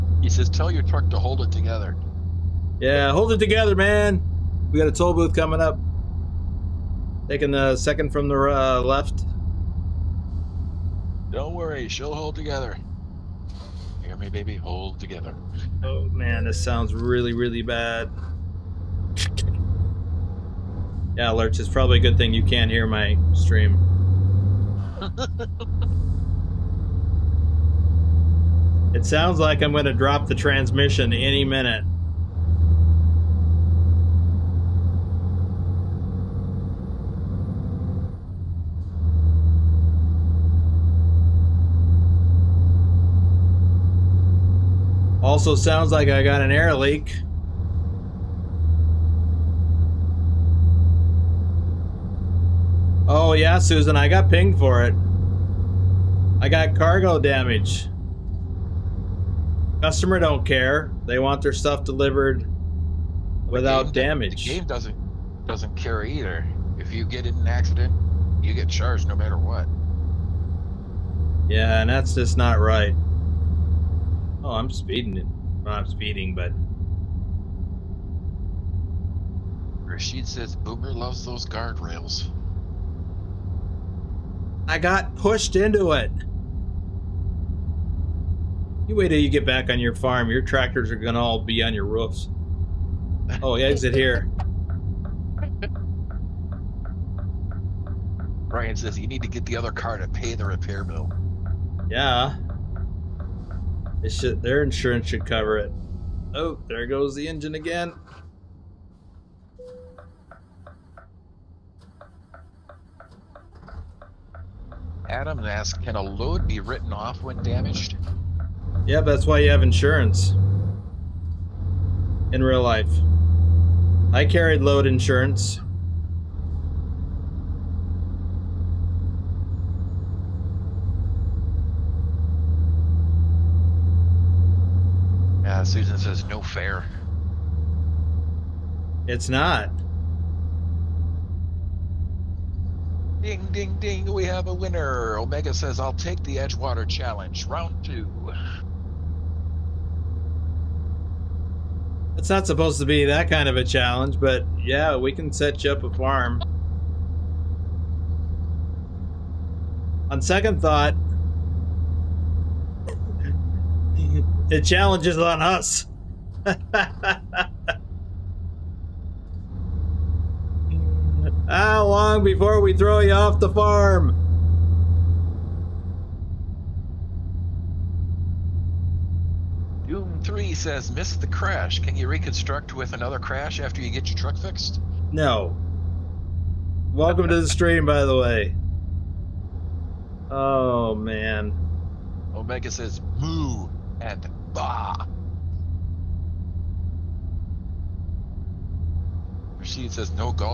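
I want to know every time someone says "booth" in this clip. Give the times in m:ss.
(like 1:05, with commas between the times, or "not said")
0:05.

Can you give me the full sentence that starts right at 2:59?
Doom 3 says, missed the crash.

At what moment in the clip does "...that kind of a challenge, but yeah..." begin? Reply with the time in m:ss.
2:33.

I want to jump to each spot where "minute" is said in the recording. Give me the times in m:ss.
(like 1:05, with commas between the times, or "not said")
0:31.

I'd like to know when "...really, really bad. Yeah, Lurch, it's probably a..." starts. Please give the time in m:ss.
0:16.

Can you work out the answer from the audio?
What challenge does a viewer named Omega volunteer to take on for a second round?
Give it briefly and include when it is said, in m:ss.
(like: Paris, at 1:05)
Edgewater Challenge, at 2:26.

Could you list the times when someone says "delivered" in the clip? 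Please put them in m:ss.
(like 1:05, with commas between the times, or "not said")
1:01.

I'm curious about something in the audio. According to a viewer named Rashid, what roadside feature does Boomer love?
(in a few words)
Guardrails.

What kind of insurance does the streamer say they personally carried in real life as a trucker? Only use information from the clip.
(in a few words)
Load insurance.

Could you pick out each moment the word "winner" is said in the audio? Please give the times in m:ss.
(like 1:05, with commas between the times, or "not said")
2:24.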